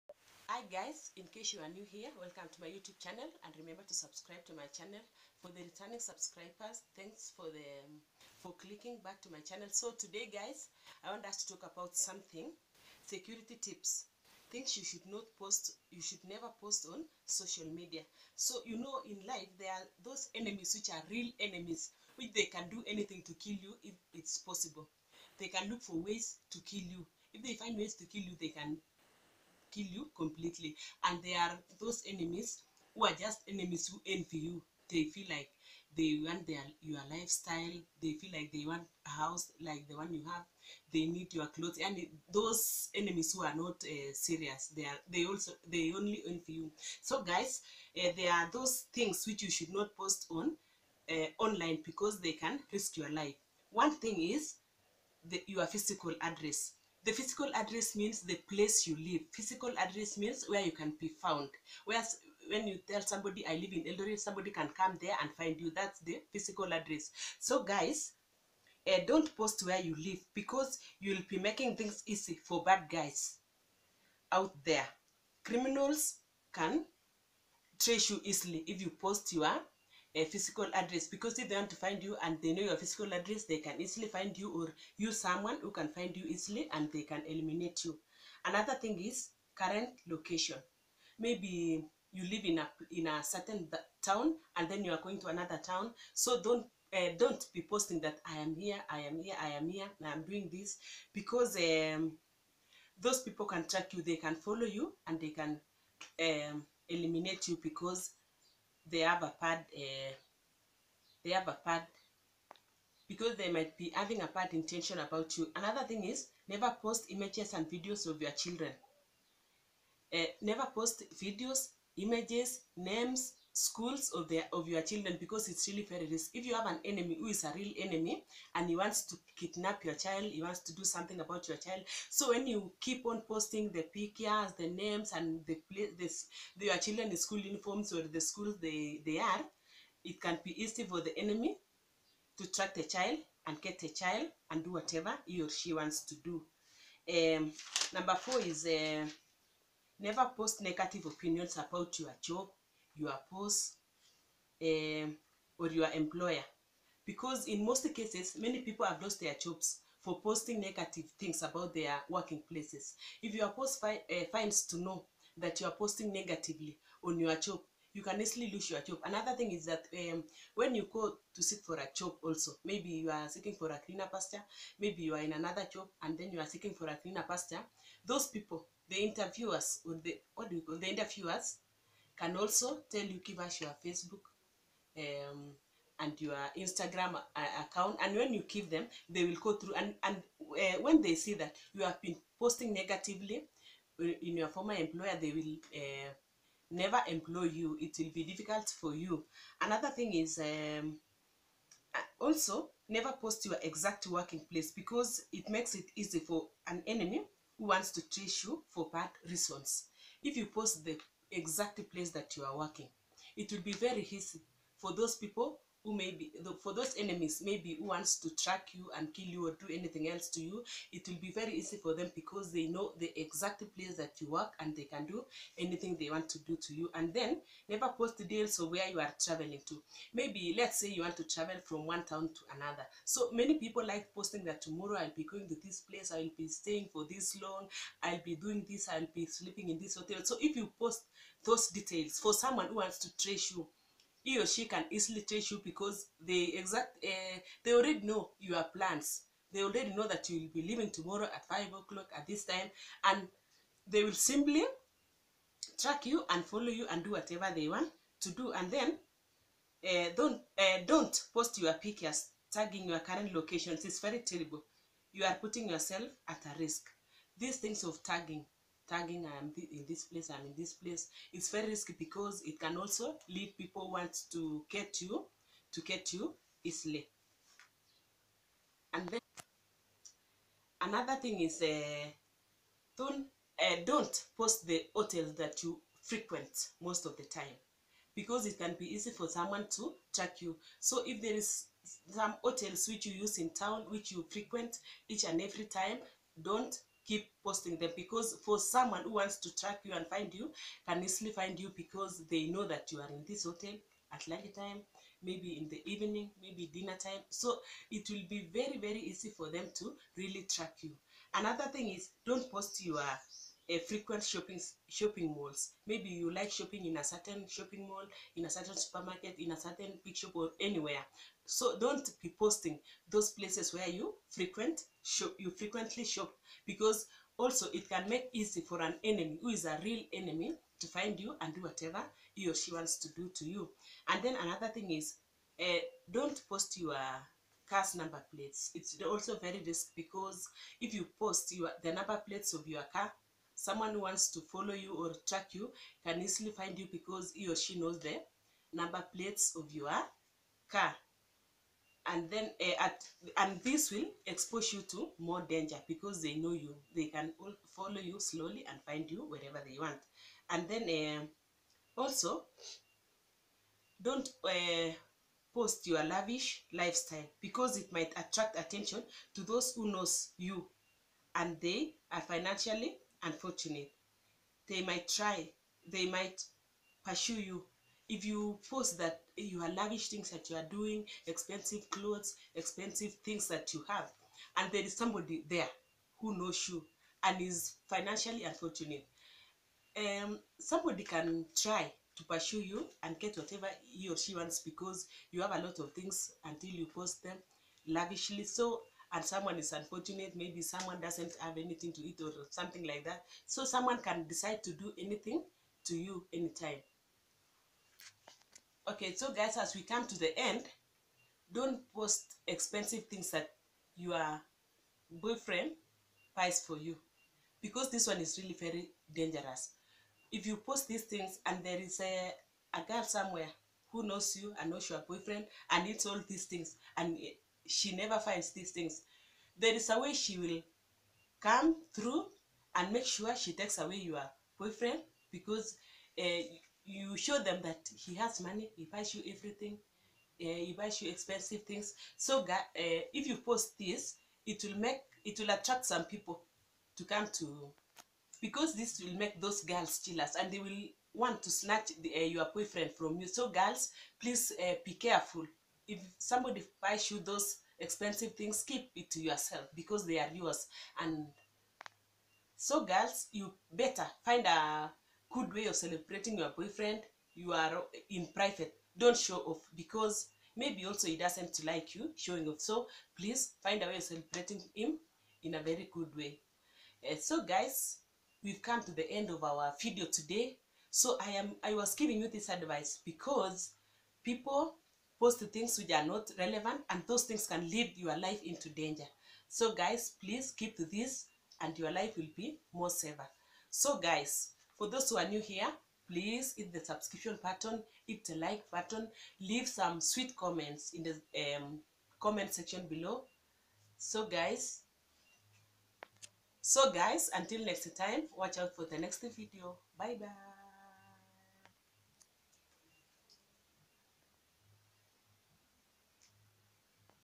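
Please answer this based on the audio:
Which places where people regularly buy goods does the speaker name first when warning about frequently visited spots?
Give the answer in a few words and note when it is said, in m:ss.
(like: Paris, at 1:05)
Shopping malls, at 5:14.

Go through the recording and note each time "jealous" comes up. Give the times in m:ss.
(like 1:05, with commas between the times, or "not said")
7:29.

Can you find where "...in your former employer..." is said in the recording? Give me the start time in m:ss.
3:13.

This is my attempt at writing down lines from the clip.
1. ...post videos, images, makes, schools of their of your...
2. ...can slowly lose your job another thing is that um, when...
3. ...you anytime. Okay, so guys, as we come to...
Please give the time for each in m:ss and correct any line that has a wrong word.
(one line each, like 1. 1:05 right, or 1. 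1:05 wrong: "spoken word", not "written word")
1. 2:00 wrong: "names", not "makes"
2. 2:48 wrong: "easily", not "slowly"
3. 6:45 right.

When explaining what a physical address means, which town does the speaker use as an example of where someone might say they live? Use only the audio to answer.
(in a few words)
Eldoret.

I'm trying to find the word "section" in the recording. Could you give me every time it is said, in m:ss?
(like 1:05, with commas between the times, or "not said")
8:22.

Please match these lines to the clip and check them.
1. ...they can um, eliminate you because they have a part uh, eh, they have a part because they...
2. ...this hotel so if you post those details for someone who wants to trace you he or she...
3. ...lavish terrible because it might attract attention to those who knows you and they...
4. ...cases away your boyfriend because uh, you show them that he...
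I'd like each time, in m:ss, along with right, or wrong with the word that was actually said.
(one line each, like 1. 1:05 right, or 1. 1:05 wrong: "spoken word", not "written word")
1. 1:45 right
2. 3:59 right
3. 6:06 wrong: "lifestyle", not "terrible"
4. 7:13 wrong: "takes", not "cases".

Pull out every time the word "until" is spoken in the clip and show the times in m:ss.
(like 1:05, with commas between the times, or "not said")
6:36, 8:27.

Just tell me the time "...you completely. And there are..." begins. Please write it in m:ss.
0:29.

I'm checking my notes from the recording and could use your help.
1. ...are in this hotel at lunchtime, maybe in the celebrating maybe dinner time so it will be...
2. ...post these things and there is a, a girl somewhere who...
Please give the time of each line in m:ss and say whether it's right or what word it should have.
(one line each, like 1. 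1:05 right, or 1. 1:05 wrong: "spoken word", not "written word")
1. 5:03 wrong: "evening", not "celebrating"
2. 7:00 right.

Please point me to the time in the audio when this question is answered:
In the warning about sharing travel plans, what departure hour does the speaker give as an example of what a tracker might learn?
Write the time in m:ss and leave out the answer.
4:11.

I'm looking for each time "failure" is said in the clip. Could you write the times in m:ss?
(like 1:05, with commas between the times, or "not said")
not said.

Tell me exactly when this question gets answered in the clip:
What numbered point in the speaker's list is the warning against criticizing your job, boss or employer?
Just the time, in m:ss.
2:27.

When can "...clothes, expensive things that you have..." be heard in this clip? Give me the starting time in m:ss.
6:21.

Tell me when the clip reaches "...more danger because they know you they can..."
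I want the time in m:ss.
5:55.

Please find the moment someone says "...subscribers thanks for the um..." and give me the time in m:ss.
0:05.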